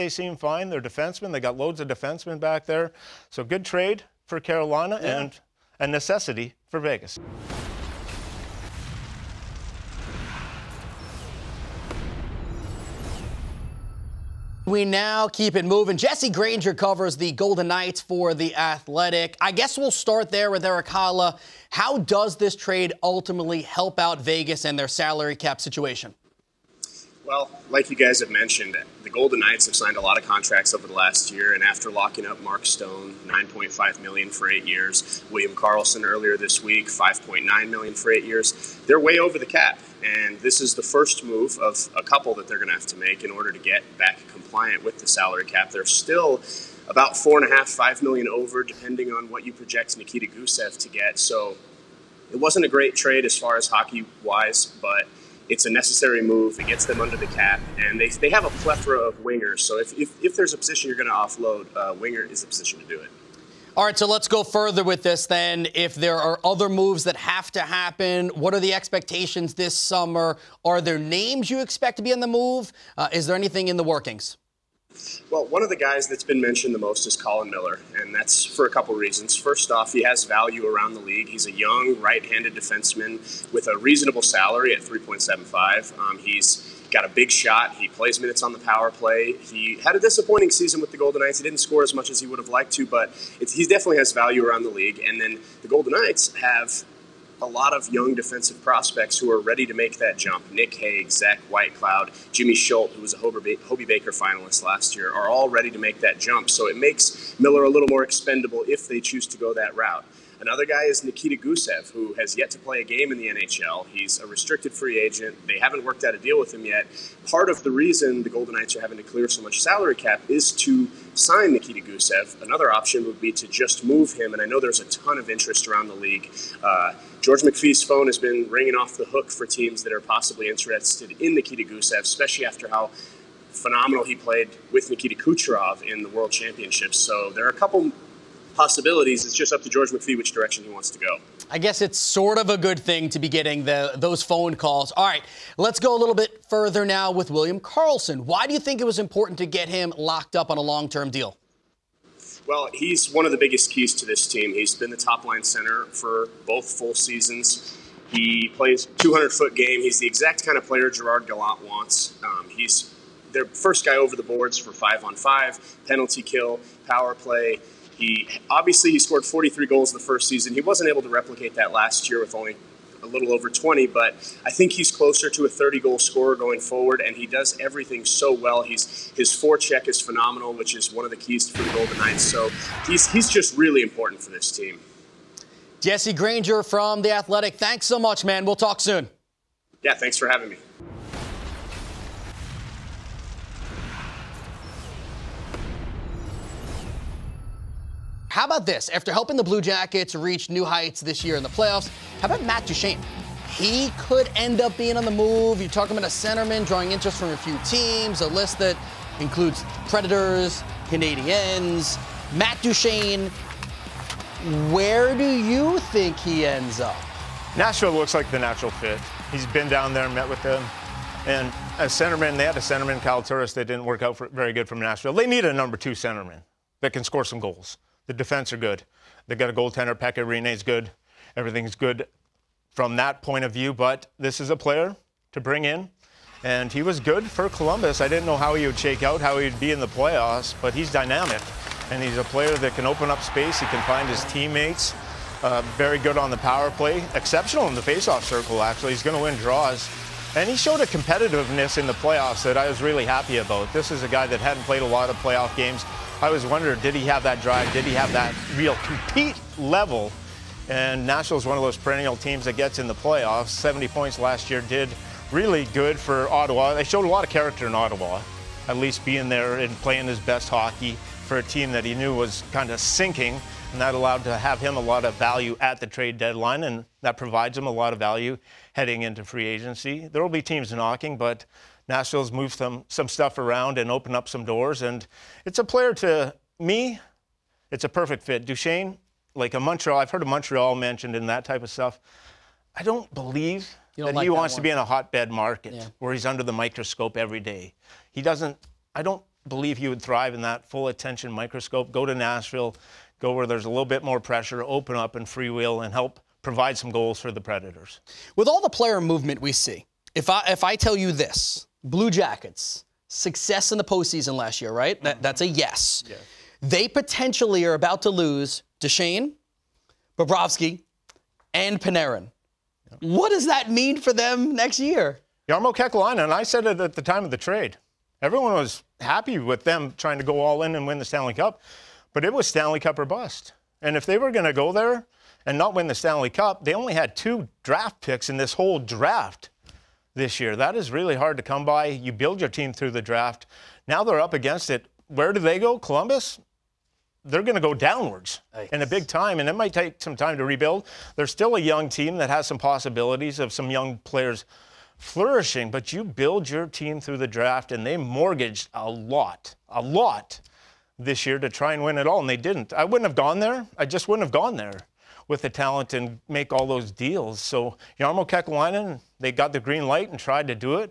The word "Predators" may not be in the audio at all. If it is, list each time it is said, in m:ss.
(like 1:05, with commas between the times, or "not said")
3:29, 5:07.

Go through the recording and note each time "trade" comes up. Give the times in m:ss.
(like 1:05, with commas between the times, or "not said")
0:03, 0:22, 0:52, 4:35, 5:27.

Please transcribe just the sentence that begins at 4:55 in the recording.
where he's under the microscope every day.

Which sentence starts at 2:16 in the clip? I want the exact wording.
So there are a couple possibilities.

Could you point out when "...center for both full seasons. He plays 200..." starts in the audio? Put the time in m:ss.
2:35.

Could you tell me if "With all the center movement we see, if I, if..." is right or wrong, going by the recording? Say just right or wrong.
wrong.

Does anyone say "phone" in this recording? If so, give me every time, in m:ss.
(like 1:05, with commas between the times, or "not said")
2:07, 2:24.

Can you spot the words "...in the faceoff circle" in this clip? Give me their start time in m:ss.
4:07.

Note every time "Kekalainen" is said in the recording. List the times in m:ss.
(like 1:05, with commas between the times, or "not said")
5:25, 6:08.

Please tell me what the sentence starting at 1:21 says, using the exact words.
He's a young right-handed defenseman with a reasonable salary at 3.75.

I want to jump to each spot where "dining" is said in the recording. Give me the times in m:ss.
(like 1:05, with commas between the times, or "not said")
not said.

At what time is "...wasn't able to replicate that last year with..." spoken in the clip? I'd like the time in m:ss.
2:50.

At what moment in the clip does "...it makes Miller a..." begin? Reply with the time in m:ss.
1:46.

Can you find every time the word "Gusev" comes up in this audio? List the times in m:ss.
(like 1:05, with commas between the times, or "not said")
0:50, 1:51, 2:01, 2:11.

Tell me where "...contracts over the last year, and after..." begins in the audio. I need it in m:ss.
0:30.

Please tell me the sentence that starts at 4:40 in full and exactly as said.
There will be teams knocking, but Nashville's moved some, some stuff around and opened up some doors.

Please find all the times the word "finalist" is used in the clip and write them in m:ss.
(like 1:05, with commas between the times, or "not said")
1:44.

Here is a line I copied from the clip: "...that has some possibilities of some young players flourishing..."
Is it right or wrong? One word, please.
right.